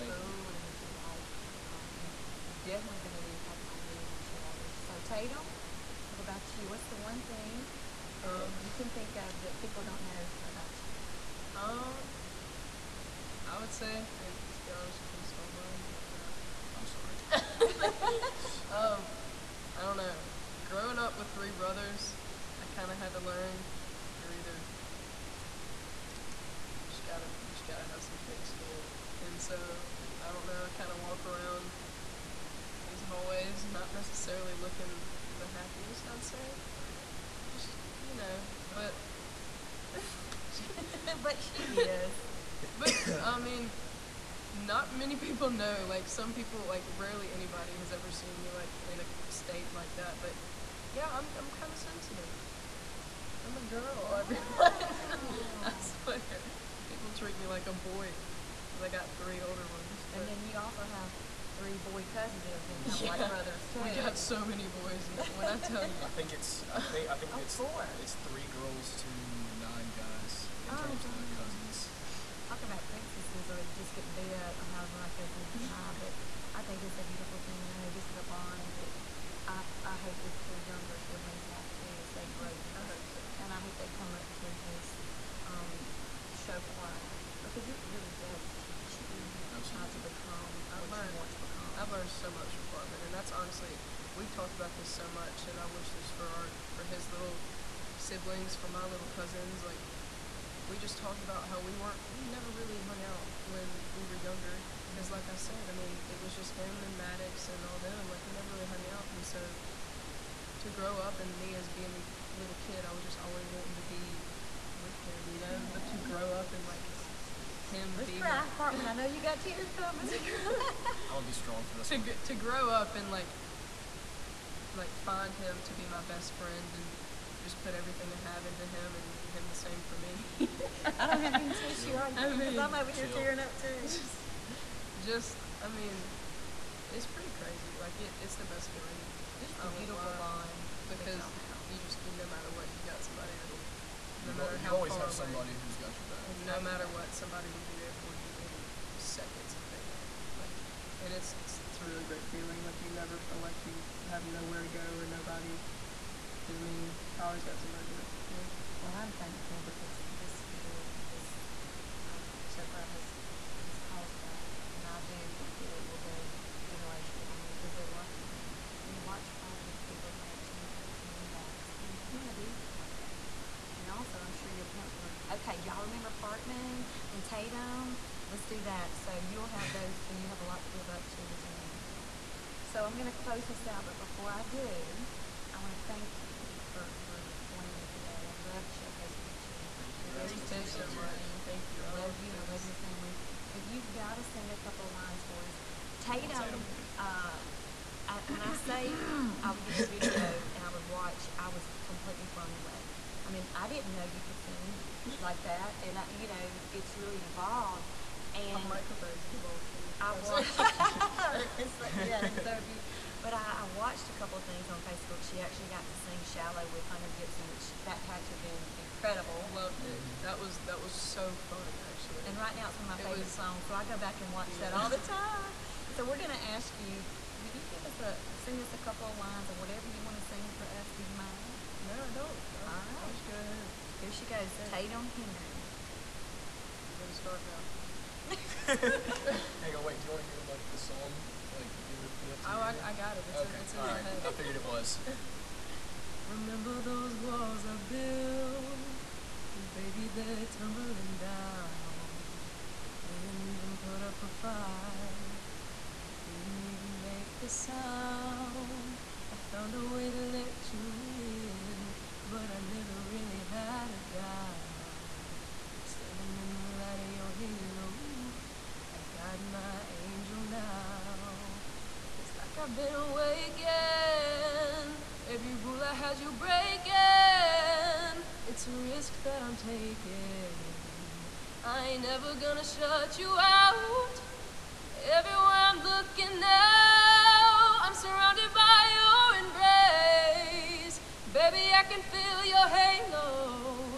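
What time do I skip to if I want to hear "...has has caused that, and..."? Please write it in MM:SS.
02:42.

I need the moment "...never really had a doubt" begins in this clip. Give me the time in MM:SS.
04:22.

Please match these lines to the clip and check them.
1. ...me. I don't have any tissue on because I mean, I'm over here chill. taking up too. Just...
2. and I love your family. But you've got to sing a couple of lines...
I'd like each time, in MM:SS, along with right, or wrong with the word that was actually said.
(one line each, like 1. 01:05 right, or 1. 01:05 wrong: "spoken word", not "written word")
1. 02:09 wrong: "tearing", not "taking"
2. 03:12 right.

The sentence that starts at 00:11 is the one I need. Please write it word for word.
Um, I would say, I mean, let's be honest, you kind of stole mine, but.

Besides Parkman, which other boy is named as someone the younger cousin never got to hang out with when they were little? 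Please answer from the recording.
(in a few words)
Maddox.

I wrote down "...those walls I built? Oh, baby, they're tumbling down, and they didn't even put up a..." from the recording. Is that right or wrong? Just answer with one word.
right.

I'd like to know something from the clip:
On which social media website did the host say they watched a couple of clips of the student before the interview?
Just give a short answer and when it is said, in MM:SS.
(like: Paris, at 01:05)
Facebook, at 03:34.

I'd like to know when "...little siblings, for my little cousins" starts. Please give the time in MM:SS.
01:37.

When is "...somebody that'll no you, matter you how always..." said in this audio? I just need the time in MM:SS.
02:23.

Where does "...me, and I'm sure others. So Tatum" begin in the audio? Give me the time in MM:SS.
00:03.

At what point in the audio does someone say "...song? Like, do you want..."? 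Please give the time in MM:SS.
04:00.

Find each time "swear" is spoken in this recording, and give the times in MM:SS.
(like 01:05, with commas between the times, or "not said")
00:55.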